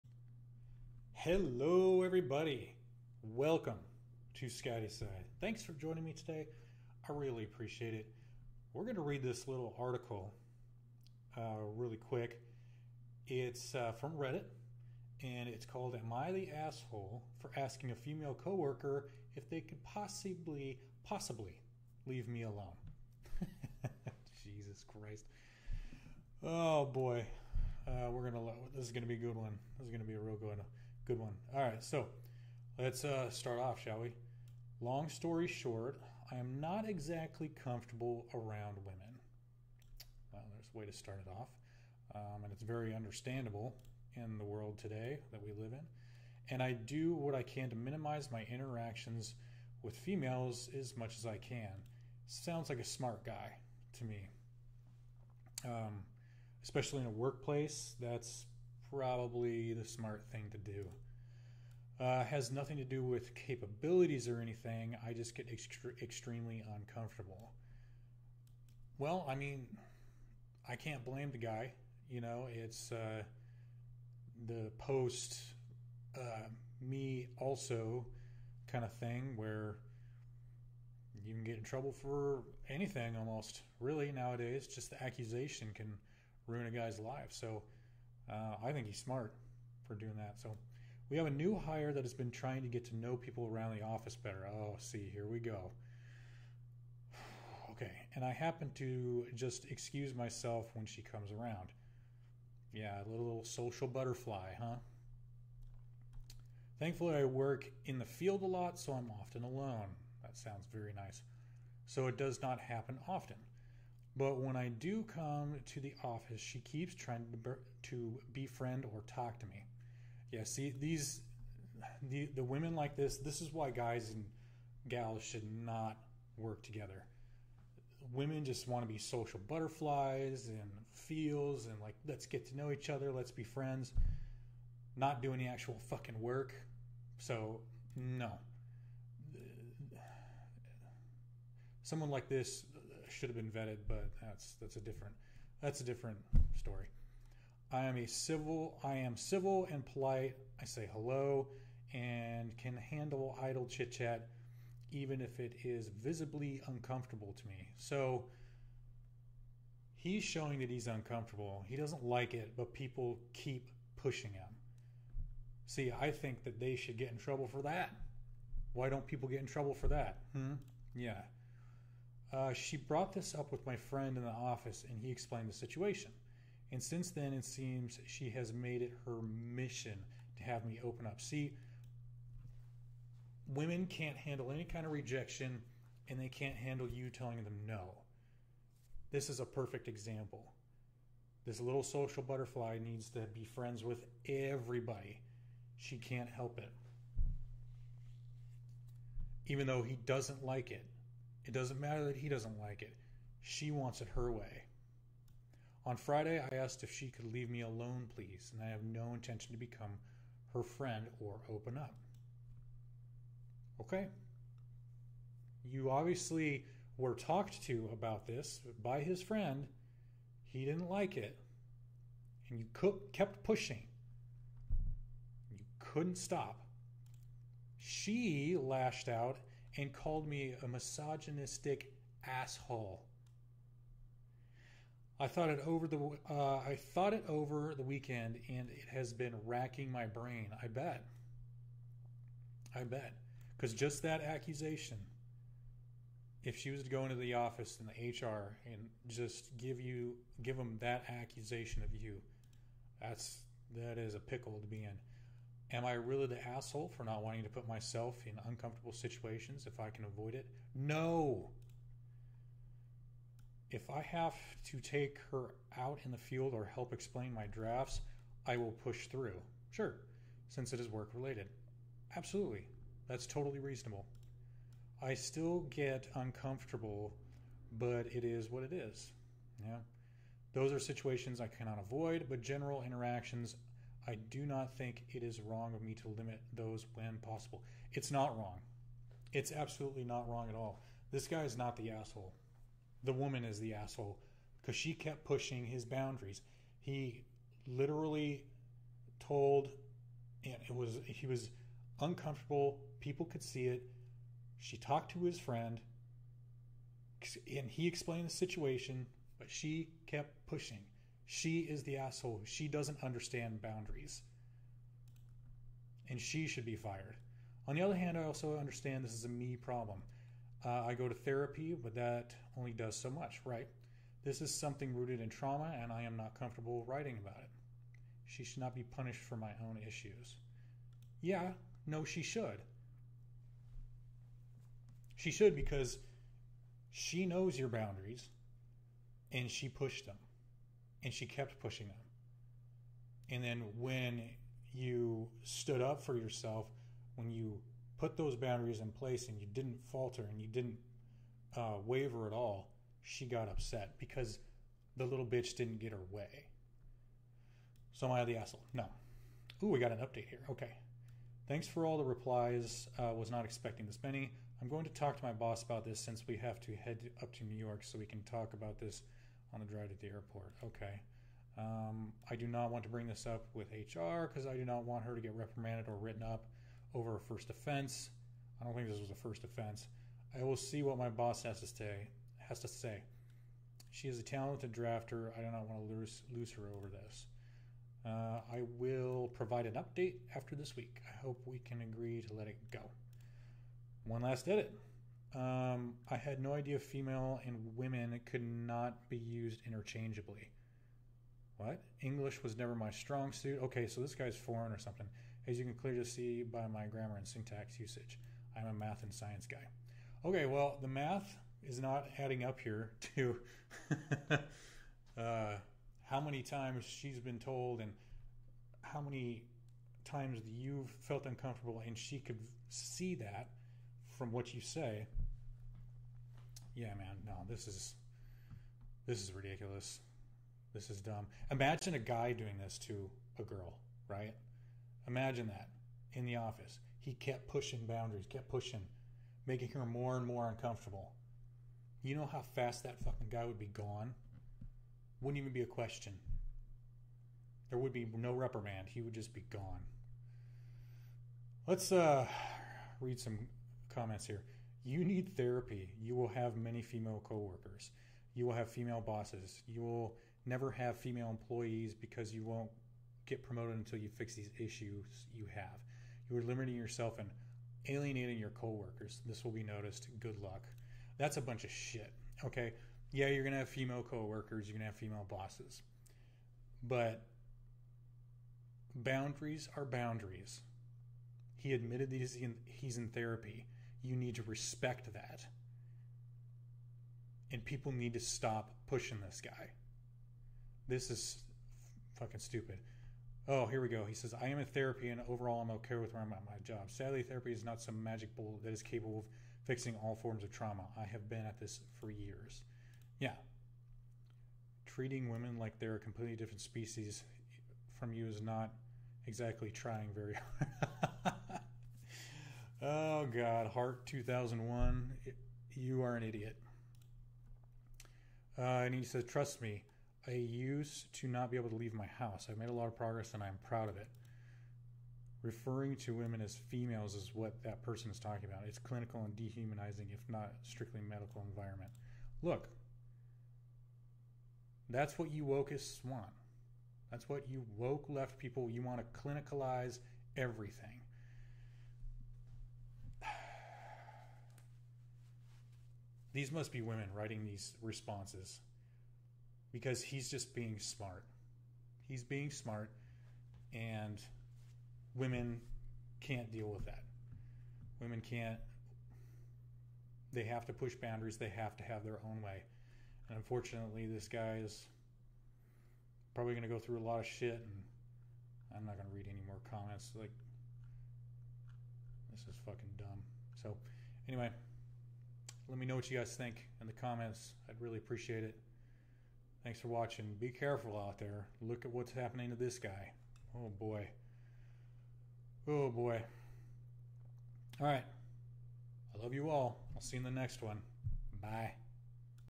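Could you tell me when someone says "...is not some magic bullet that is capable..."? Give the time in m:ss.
8:17.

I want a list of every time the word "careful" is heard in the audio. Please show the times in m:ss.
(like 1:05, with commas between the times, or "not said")
9:40.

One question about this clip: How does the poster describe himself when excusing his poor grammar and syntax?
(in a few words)
A math and science guy.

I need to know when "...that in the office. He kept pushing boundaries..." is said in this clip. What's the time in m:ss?
7:15.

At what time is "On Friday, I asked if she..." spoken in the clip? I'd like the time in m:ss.
3:25.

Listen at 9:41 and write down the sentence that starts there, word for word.
Look at what's happening to this guy.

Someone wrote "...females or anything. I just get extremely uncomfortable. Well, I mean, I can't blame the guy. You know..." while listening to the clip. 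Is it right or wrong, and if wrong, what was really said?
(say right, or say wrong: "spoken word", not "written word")
wrong: "capabilities", not "females".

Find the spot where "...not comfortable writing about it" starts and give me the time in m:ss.
5:26.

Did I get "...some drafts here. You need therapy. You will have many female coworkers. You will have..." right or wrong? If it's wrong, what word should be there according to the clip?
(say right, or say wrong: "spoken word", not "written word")
wrong: "comments", not "drafts".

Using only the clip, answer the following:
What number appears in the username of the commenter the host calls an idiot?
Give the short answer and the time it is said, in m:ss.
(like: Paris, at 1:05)
2001, at 8:34.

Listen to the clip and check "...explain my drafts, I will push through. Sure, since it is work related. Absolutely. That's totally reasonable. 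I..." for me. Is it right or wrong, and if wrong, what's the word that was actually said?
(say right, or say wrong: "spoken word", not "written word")
right.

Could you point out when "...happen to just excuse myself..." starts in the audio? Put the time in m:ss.
1:38.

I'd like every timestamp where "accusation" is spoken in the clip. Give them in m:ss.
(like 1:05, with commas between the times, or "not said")
1:25, 4:04, 4:11.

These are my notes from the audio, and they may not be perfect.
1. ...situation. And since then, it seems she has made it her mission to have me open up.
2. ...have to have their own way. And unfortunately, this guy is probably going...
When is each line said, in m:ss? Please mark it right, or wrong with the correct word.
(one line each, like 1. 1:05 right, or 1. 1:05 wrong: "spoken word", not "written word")
1. 2:55 right
2. 9:21 right.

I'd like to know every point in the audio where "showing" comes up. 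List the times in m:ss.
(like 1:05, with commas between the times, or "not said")
2:40.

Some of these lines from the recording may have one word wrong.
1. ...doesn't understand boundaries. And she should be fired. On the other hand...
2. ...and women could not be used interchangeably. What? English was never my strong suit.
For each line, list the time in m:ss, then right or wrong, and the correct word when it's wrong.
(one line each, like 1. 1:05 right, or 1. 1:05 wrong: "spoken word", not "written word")
1. 5:12 right
2. 6:37 right.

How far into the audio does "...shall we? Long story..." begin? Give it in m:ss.
0:33.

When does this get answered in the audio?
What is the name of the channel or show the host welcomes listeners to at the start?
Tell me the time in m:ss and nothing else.
0:04.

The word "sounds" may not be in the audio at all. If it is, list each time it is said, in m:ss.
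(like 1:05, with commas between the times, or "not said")
0:52, 1:50.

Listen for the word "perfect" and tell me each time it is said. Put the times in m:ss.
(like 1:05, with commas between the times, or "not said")
3:09.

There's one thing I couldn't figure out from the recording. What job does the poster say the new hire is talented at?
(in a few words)
Drafter.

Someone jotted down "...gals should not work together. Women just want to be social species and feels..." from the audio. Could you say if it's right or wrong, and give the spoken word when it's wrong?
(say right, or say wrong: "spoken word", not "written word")
wrong: "butterflies", not "species".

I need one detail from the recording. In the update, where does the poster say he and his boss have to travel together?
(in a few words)
New York.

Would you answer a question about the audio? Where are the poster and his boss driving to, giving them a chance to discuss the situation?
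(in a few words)
The airport.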